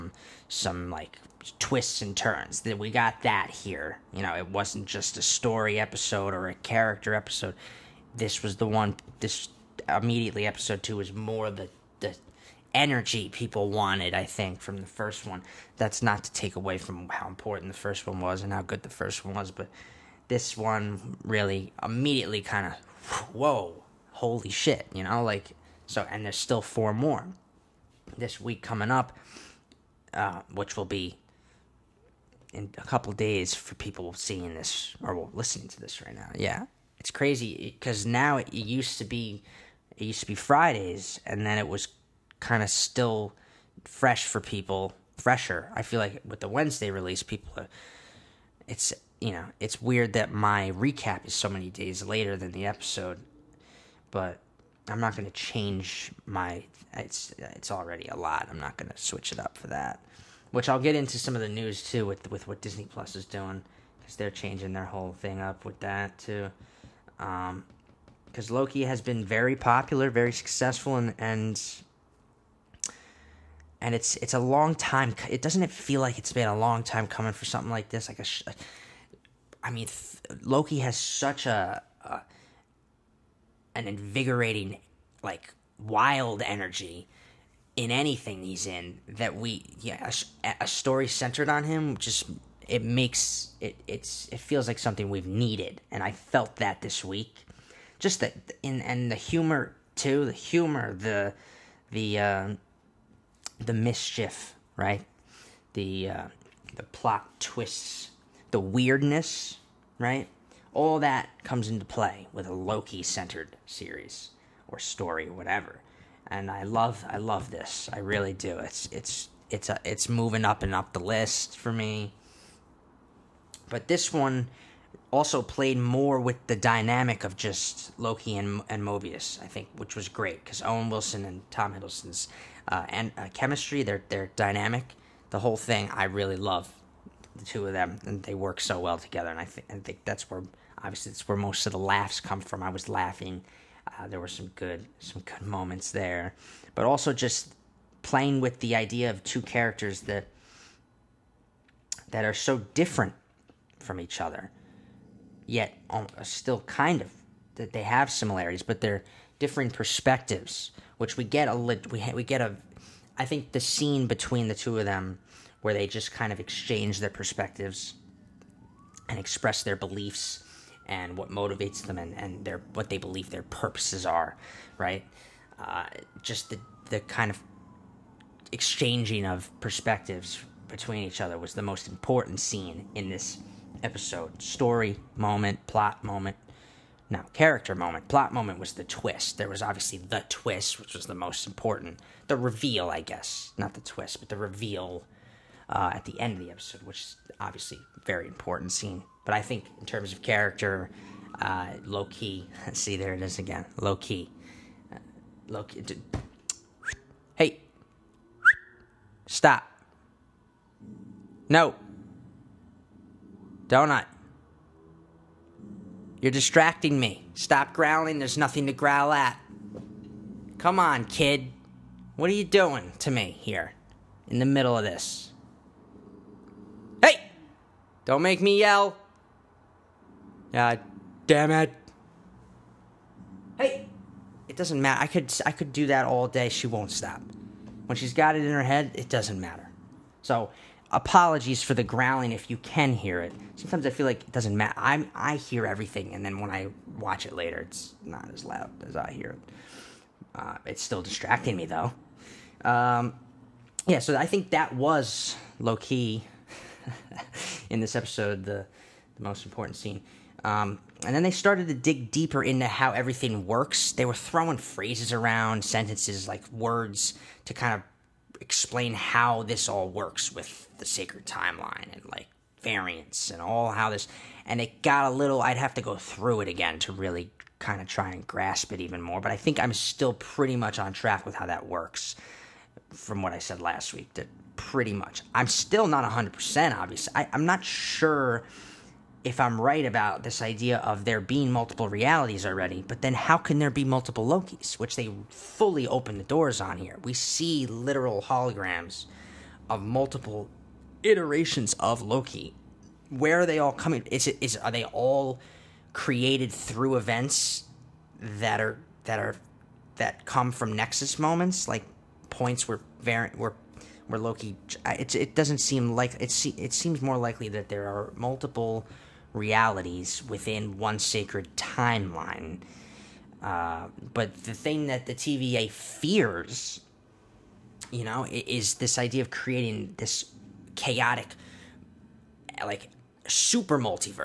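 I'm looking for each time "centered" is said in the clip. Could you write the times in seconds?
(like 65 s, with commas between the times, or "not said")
91 s, 112 s.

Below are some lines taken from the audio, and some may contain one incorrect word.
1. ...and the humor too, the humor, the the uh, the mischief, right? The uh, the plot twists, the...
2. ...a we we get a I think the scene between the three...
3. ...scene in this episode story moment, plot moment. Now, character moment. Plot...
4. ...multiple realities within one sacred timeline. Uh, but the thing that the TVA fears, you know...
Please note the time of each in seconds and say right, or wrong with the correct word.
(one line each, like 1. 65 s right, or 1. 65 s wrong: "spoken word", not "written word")
1. 98 s right
2. 161 s wrong: "two", not "three"
3. 182 s right
4. 318 s right.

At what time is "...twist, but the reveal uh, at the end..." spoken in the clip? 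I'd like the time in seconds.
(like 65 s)
193 s.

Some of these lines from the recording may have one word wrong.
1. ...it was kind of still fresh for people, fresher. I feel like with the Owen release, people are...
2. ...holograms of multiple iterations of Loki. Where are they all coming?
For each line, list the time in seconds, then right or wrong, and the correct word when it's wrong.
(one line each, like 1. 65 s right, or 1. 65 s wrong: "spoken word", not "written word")
1. 41 s wrong: "Wednesday", not "Owen"
2. 298 s right.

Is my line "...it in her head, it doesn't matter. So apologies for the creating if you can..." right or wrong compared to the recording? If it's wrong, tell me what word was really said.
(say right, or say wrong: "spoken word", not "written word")
wrong: "growling", not "creating".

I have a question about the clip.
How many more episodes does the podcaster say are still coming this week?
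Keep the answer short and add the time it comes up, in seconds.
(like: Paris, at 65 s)
4, at 26 s.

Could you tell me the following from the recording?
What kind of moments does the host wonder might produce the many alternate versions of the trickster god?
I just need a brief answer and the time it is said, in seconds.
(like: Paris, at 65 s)
Nexus moments, at 310 s.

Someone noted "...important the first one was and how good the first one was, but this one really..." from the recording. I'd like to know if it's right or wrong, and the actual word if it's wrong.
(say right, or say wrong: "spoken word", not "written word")
right.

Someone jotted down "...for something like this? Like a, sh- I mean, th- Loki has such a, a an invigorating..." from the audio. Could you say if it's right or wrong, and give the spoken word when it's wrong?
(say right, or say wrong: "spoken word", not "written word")
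right.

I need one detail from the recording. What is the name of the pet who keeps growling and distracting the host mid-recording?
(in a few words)
Donut.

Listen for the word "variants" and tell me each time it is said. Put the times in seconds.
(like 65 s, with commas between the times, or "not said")
272 s, 313 s.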